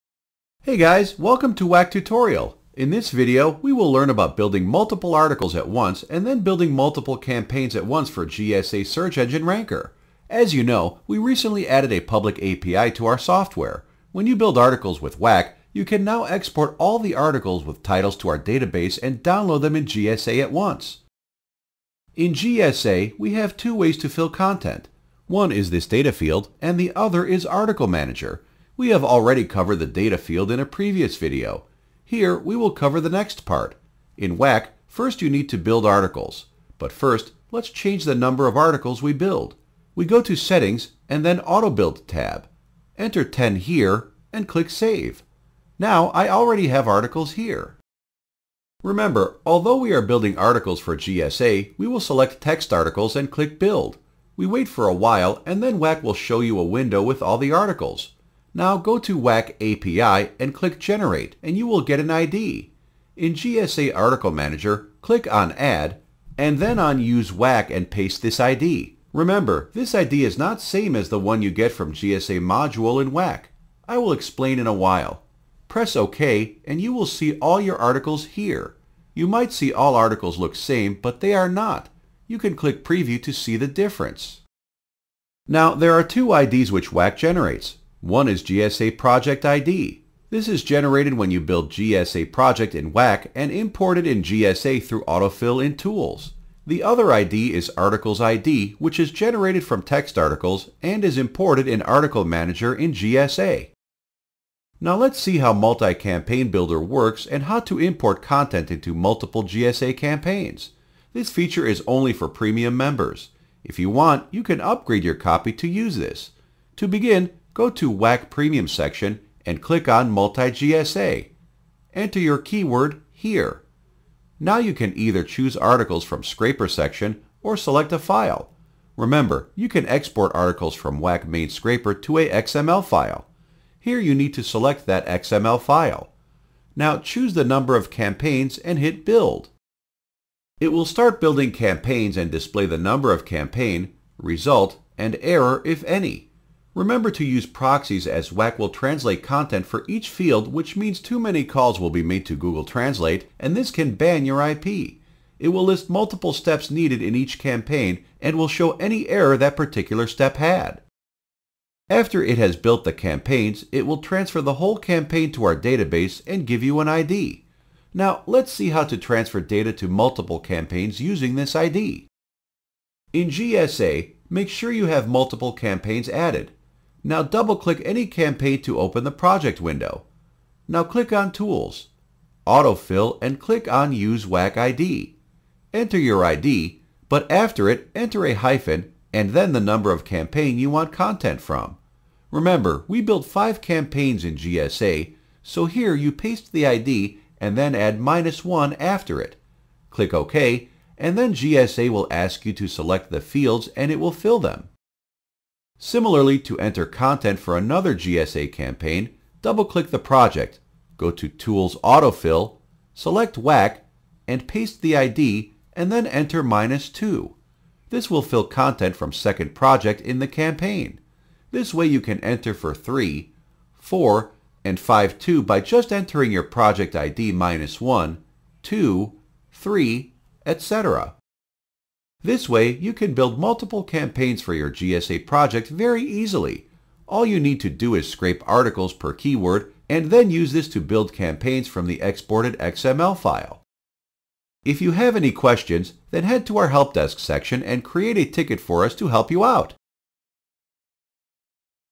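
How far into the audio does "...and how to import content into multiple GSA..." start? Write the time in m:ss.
1:47.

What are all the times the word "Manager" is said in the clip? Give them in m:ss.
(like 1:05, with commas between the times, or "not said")
0:27, 1:04, 1:42.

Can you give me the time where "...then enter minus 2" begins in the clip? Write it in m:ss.
3:35.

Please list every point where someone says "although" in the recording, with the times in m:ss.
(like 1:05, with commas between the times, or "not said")
0:49.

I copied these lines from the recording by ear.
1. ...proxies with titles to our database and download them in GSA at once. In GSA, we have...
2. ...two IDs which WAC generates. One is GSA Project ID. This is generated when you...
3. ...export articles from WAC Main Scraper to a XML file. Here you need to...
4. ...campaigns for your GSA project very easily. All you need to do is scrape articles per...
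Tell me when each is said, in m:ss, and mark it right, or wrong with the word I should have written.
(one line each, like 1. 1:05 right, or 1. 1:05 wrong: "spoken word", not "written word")
1. 0:17 wrong: "articles", not "proxies"
2. 1:26 right
3. 2:09 right
4. 3:53 right.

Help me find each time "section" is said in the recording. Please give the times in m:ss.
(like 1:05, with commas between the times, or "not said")
1:58, 2:06, 4:07.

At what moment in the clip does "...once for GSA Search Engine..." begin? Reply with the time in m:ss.
0:07.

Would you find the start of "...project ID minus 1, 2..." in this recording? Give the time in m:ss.
3:46.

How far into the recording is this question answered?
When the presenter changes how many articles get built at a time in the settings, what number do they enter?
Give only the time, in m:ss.
0:42.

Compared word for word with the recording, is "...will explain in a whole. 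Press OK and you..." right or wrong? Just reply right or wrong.
wrong.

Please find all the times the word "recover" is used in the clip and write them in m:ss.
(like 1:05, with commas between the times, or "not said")
not said.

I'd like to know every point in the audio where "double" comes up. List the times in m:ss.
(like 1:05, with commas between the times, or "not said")
2:57, 3:29.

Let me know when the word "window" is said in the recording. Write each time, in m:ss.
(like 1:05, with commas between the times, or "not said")
0:56, 2:59.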